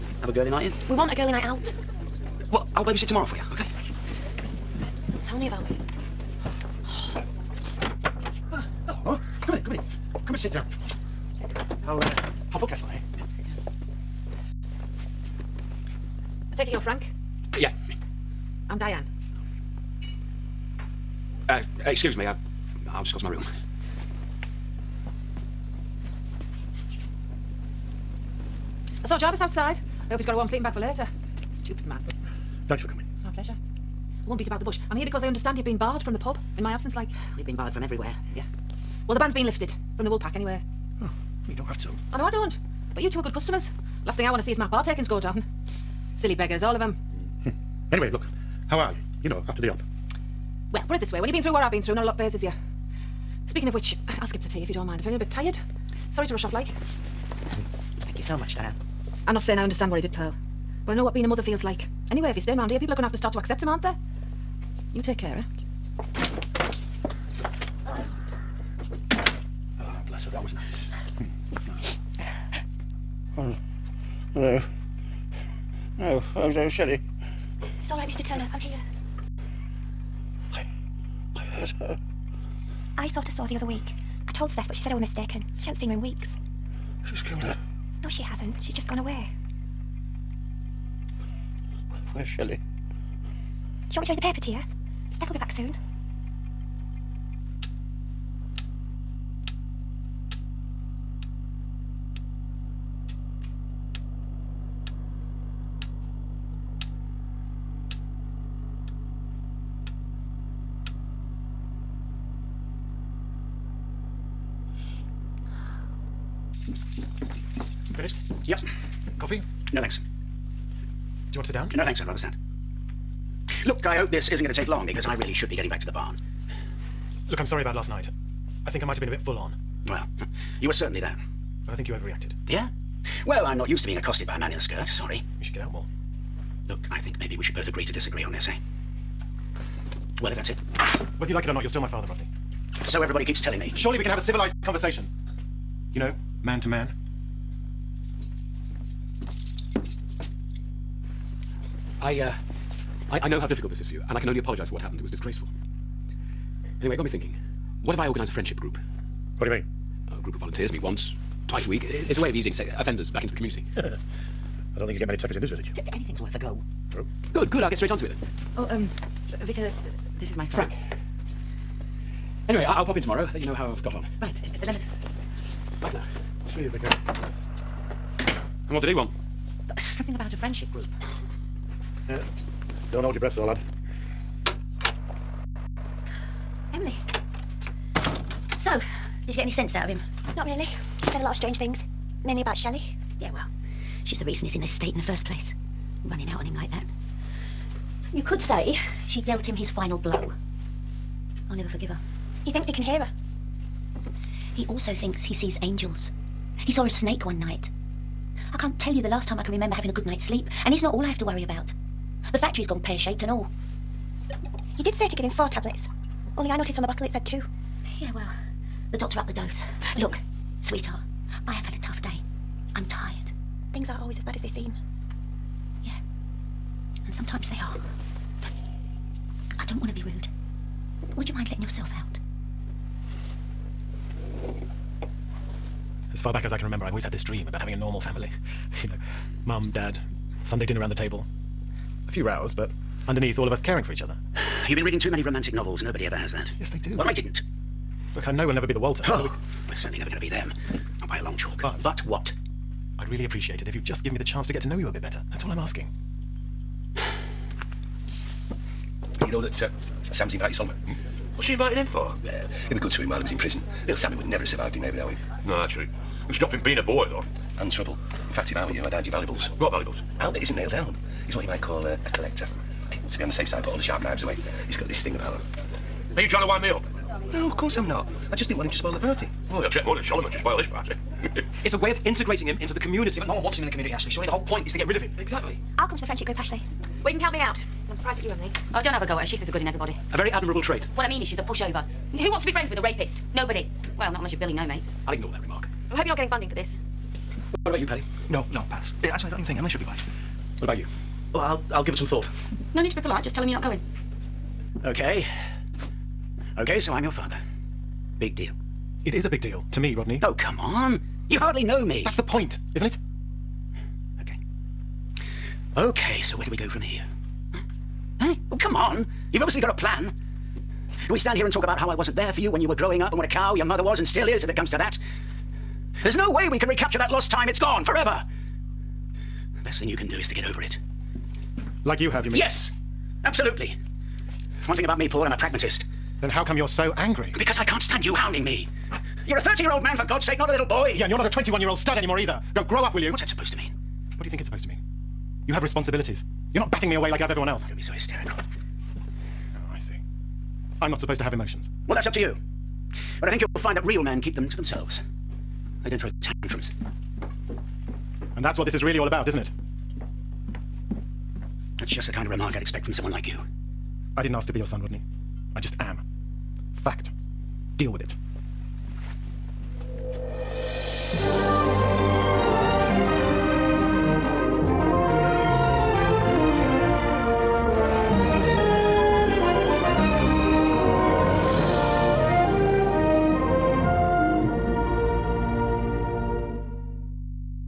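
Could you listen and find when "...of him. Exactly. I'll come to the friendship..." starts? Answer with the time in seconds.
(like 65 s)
284 s.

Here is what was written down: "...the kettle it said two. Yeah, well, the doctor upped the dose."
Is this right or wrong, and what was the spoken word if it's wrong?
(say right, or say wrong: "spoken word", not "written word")
wrong: "bottle", not "kettle".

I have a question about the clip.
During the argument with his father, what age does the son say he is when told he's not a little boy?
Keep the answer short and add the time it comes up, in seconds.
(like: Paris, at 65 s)
30, at 339 s.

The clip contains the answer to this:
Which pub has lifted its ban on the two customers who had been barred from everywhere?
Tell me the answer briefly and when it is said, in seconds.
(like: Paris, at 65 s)
The Woolpack, at 40 s.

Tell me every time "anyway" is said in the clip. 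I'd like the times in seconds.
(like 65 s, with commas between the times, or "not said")
40 s, 47 s, 62 s, 156 s, 172 s.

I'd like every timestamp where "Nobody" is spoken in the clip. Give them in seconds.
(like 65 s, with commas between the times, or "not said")
245 s, 293 s.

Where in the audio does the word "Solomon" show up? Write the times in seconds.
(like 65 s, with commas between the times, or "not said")
260 s, 280 s.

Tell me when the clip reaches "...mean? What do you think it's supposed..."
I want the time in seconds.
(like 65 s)
343 s.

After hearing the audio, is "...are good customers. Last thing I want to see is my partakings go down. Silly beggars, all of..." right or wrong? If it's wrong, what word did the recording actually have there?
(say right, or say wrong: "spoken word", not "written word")
right.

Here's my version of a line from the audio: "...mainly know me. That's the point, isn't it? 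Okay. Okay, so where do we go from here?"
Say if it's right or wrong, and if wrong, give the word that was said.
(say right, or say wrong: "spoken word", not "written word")
wrong: "hardly", not "mainly".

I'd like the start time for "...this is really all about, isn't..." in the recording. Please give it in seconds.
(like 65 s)
358 s.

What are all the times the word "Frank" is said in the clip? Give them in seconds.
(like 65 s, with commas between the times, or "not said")
16 s, 170 s.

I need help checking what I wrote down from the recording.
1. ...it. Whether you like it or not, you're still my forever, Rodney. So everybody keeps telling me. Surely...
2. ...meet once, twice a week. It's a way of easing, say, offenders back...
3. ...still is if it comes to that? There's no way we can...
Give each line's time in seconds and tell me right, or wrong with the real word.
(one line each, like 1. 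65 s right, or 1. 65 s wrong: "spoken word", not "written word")
1. 140 s wrong: "father", not "forever"
2. 160 s right
3. 324 s right.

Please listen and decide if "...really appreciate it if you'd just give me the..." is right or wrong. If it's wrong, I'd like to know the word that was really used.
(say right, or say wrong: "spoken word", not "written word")
right.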